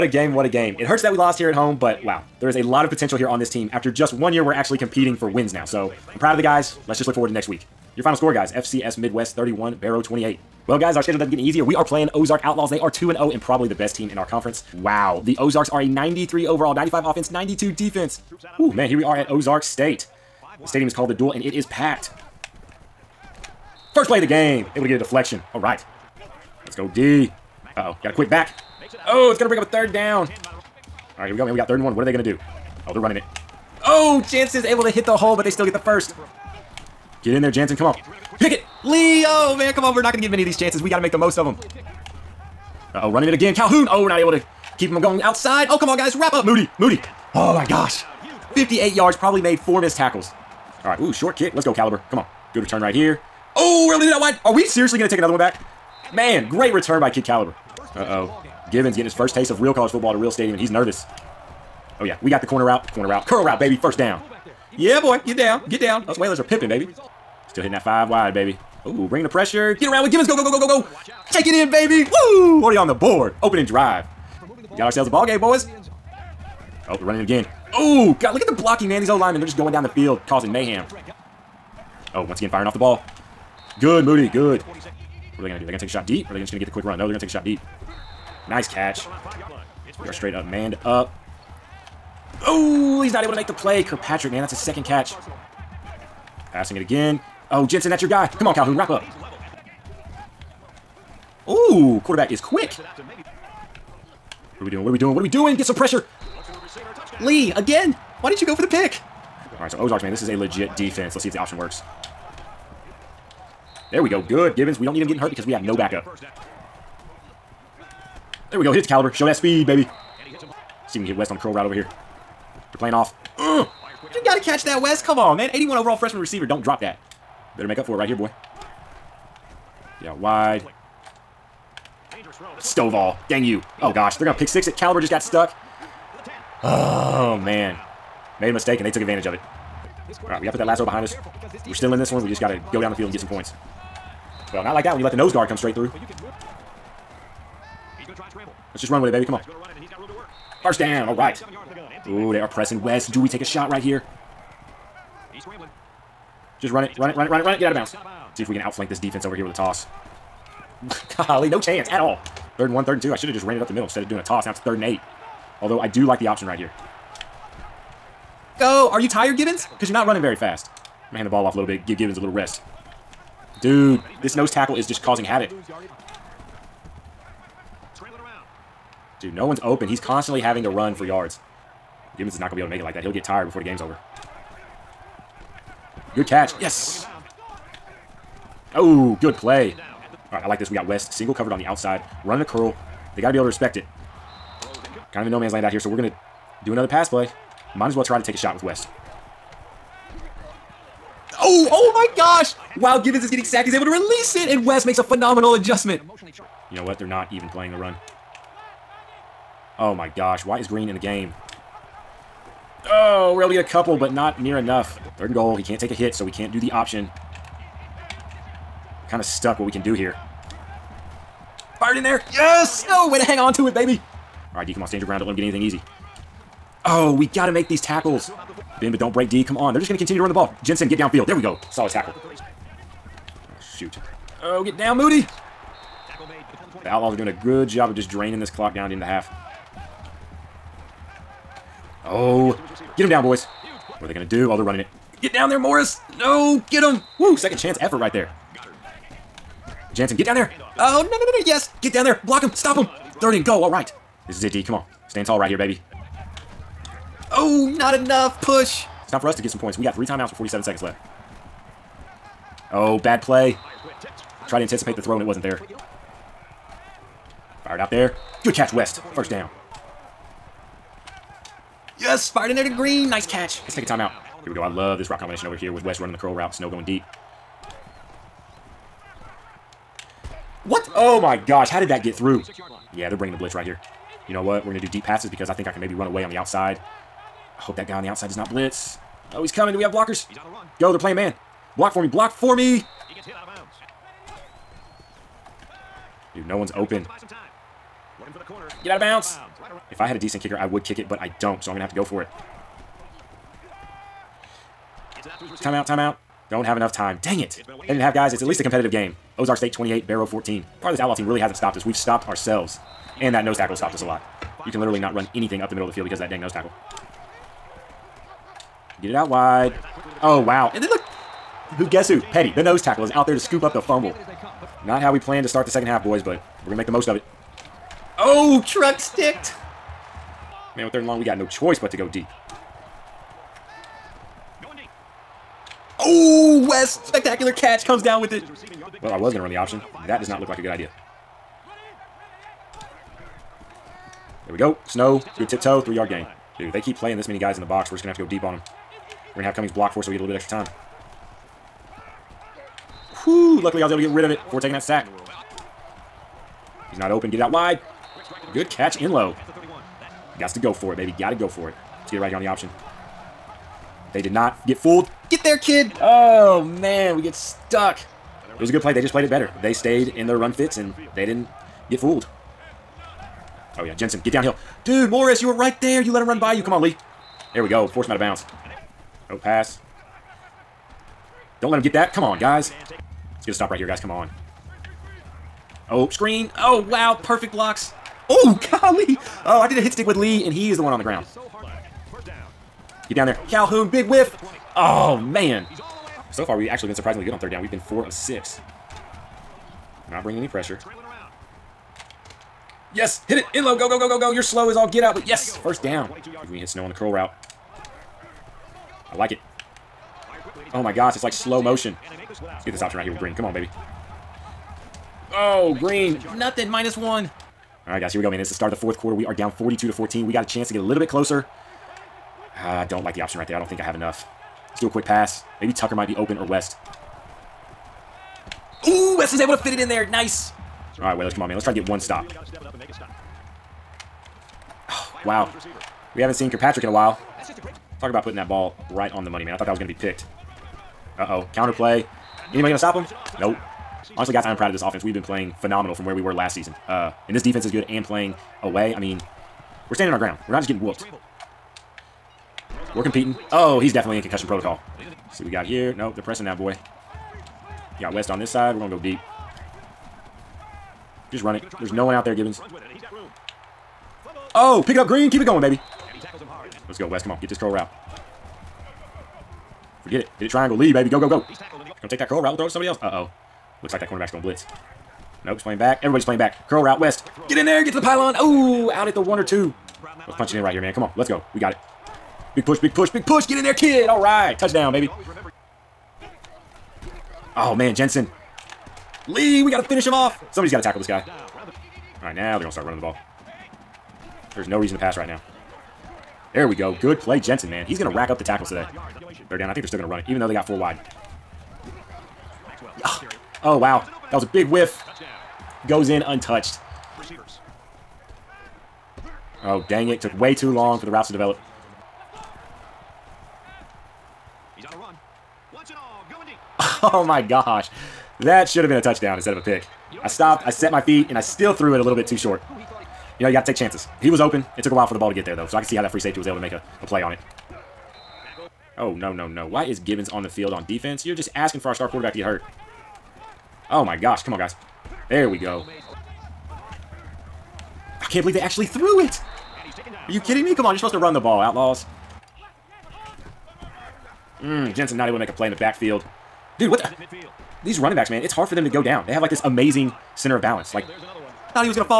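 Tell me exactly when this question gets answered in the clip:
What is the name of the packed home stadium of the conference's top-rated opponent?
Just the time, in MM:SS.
00:21.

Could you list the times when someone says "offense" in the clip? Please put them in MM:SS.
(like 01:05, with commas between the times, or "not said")
00:17, 07:24.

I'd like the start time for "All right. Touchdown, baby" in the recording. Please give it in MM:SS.
08:04.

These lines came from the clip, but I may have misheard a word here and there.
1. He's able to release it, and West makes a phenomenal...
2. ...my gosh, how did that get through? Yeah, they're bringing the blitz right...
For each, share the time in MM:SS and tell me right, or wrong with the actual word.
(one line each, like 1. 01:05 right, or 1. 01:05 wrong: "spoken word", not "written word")
1. 03:23 right
2. 04:41 right.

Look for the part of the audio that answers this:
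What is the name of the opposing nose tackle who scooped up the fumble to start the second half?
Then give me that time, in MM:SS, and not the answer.
05:22.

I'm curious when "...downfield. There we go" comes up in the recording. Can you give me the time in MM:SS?
03:50.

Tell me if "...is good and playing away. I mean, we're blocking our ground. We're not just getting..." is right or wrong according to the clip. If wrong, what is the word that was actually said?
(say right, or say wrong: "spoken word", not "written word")
wrong: "standing", not "blocking".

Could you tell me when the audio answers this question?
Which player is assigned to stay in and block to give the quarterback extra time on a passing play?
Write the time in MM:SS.
05:49.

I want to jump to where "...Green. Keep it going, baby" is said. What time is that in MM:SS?
07:45.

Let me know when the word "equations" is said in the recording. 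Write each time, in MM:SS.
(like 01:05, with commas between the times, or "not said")
not said.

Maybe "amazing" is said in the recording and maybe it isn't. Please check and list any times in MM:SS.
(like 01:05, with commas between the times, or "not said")
09:09.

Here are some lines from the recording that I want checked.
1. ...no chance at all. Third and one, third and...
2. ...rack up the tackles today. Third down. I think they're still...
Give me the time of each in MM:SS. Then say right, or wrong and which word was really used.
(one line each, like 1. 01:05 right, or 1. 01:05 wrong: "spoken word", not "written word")
1. 02:41 right
2. 08:18 right.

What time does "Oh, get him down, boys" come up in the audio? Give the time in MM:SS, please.
04:02.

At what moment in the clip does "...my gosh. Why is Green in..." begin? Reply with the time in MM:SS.
03:29.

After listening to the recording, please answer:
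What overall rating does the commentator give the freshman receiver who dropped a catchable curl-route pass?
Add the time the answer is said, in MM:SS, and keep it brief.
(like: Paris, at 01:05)
81, at 02:05.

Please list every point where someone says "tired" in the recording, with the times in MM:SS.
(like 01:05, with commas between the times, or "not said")
02:49, 03:03.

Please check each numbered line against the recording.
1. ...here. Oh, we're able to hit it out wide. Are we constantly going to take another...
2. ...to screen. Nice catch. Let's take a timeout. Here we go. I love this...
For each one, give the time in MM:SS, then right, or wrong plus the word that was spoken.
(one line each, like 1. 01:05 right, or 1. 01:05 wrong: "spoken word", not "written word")
1. 00:52 wrong: "seriously", not "constantly"
2. 04:32 wrong: "green", not "screen".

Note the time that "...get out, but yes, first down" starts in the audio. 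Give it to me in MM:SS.
06:44.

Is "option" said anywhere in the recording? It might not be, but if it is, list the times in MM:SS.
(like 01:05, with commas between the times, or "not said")
01:51, 02:46, 03:36, 05:39, 06:02, 06:52, 07:03.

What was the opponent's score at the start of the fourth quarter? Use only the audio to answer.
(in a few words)
42.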